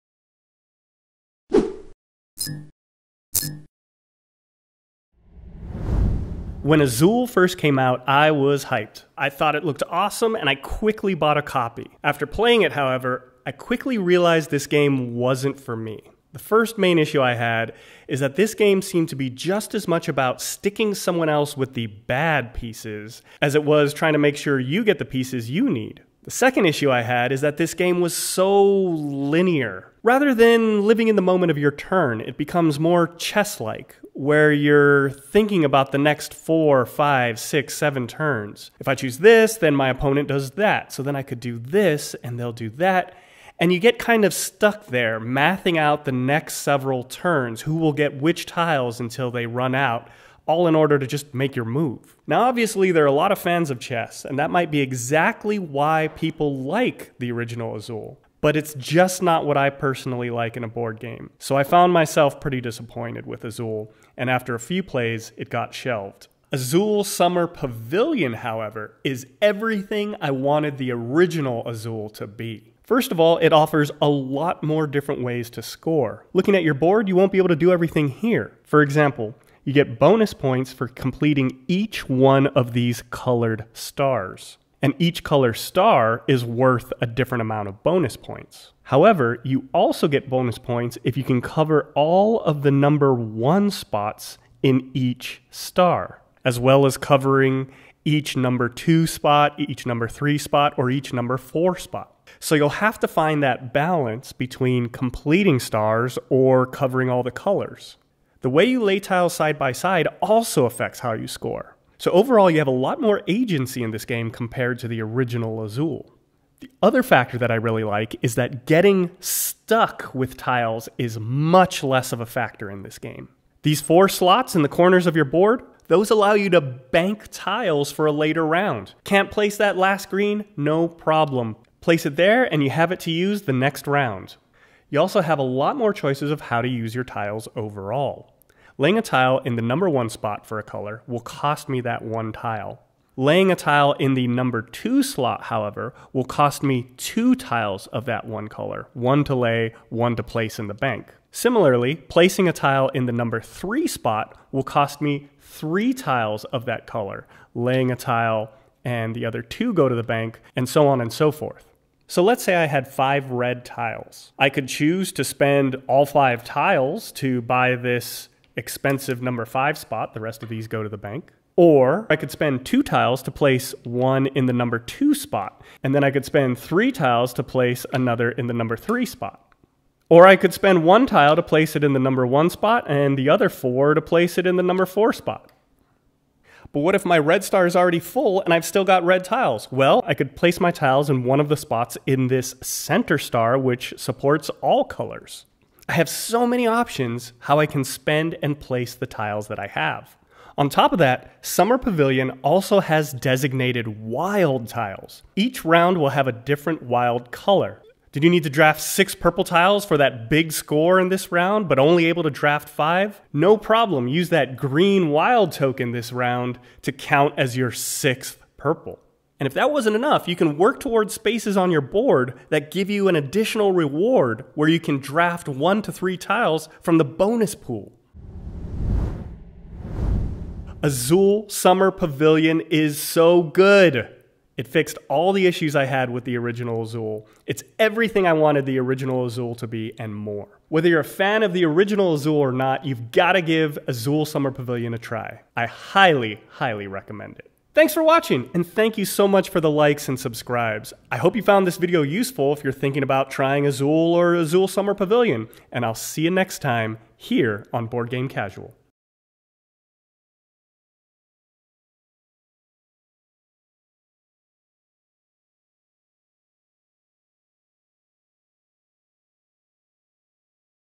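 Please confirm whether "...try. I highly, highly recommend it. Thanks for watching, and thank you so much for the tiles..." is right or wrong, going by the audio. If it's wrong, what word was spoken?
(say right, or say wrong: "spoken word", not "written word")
wrong: "likes", not "tiles".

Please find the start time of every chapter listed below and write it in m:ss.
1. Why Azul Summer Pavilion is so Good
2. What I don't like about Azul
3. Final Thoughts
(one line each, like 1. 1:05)
1. 1:06
2. 0:16
3. 3:49.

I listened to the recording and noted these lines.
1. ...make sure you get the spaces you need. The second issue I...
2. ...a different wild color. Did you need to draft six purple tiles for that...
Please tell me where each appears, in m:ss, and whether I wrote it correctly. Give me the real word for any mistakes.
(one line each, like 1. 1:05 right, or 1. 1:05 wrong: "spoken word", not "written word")
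1. 0:24 wrong: "pieces", not "spaces"
2. 3:26 right.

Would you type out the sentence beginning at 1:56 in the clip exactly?
The other factor that I really like is that getting stuck with tiles is much less of a factor in this game.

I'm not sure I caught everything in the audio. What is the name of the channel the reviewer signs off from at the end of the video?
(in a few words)
Board Game Casual.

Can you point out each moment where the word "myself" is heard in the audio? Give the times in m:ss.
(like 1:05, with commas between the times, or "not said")
1:01.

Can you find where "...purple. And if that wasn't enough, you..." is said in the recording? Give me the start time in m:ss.
3:38.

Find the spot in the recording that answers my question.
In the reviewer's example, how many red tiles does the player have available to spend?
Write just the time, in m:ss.
2:42.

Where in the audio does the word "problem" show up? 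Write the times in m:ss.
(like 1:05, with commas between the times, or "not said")
2:10, 3:33.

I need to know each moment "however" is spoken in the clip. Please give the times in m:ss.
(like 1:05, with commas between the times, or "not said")
0:12, 1:08, 1:28, 2:25.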